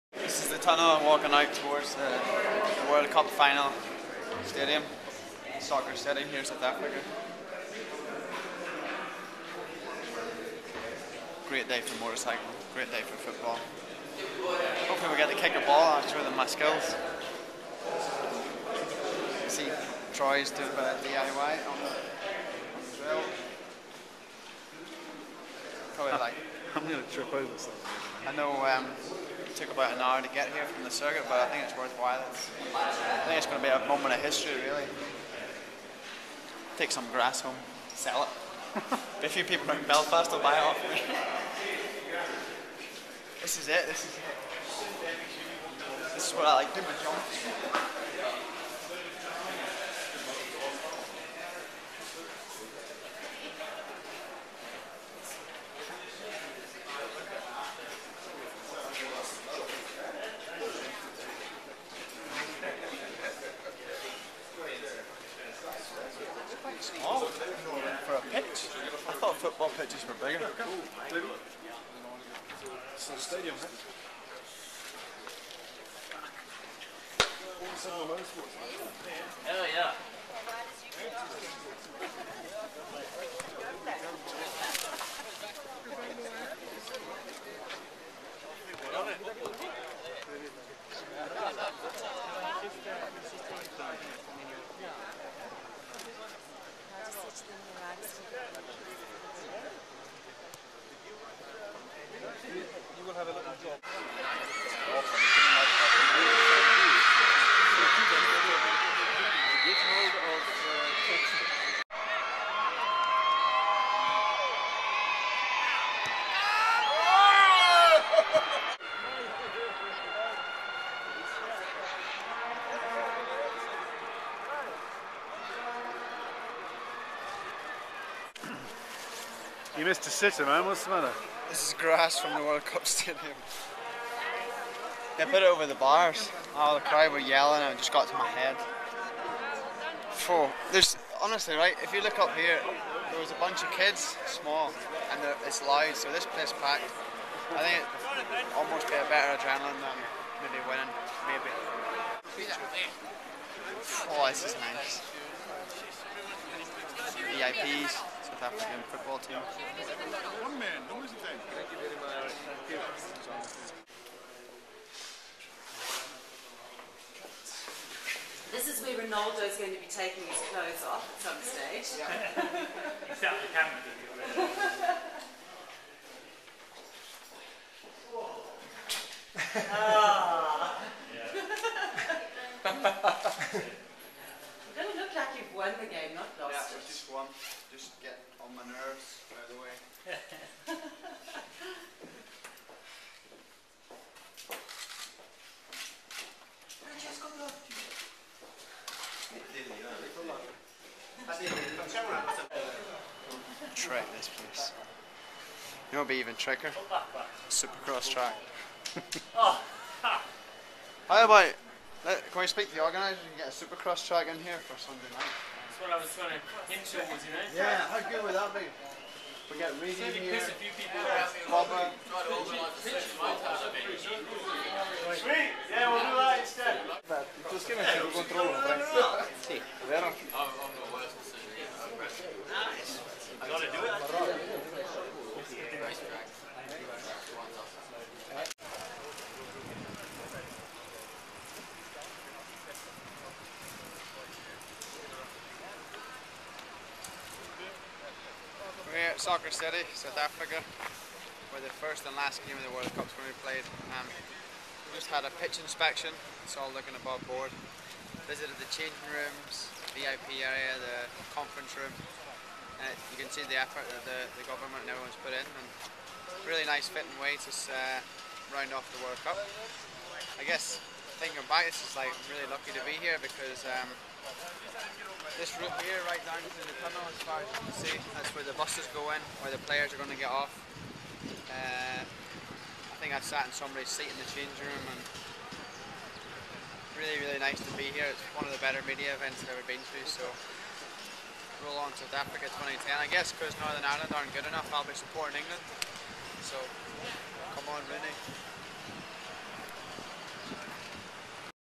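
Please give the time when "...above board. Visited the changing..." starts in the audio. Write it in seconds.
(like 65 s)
256 s.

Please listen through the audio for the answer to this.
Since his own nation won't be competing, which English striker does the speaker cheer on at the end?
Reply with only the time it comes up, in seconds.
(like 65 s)
297 s.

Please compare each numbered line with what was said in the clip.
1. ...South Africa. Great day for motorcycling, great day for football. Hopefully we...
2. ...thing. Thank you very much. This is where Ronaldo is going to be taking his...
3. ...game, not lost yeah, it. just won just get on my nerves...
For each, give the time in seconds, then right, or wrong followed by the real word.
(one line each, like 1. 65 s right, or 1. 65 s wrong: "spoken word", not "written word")
1. 6 s right
2. 161 s right
3. 185 s right.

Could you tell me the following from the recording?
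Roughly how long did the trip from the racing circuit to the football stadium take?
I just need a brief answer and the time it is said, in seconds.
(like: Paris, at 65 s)
about an hour, at 29 s.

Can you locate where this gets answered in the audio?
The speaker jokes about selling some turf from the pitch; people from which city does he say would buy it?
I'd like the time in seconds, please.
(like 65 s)
39 s.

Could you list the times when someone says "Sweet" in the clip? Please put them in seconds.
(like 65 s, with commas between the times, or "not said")
221 s.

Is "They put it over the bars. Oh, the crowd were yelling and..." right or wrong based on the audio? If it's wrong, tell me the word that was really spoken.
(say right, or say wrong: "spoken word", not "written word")
right.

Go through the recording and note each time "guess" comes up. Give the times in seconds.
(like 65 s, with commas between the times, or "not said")
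270 s, 293 s.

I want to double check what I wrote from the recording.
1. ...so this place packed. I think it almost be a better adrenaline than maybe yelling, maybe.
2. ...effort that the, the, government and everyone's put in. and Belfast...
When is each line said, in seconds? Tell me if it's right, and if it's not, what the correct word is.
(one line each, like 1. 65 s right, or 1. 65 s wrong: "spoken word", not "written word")
1. 145 s wrong: "winning", not "yelling"
2. 263 s wrong: "Really", not "Belfast".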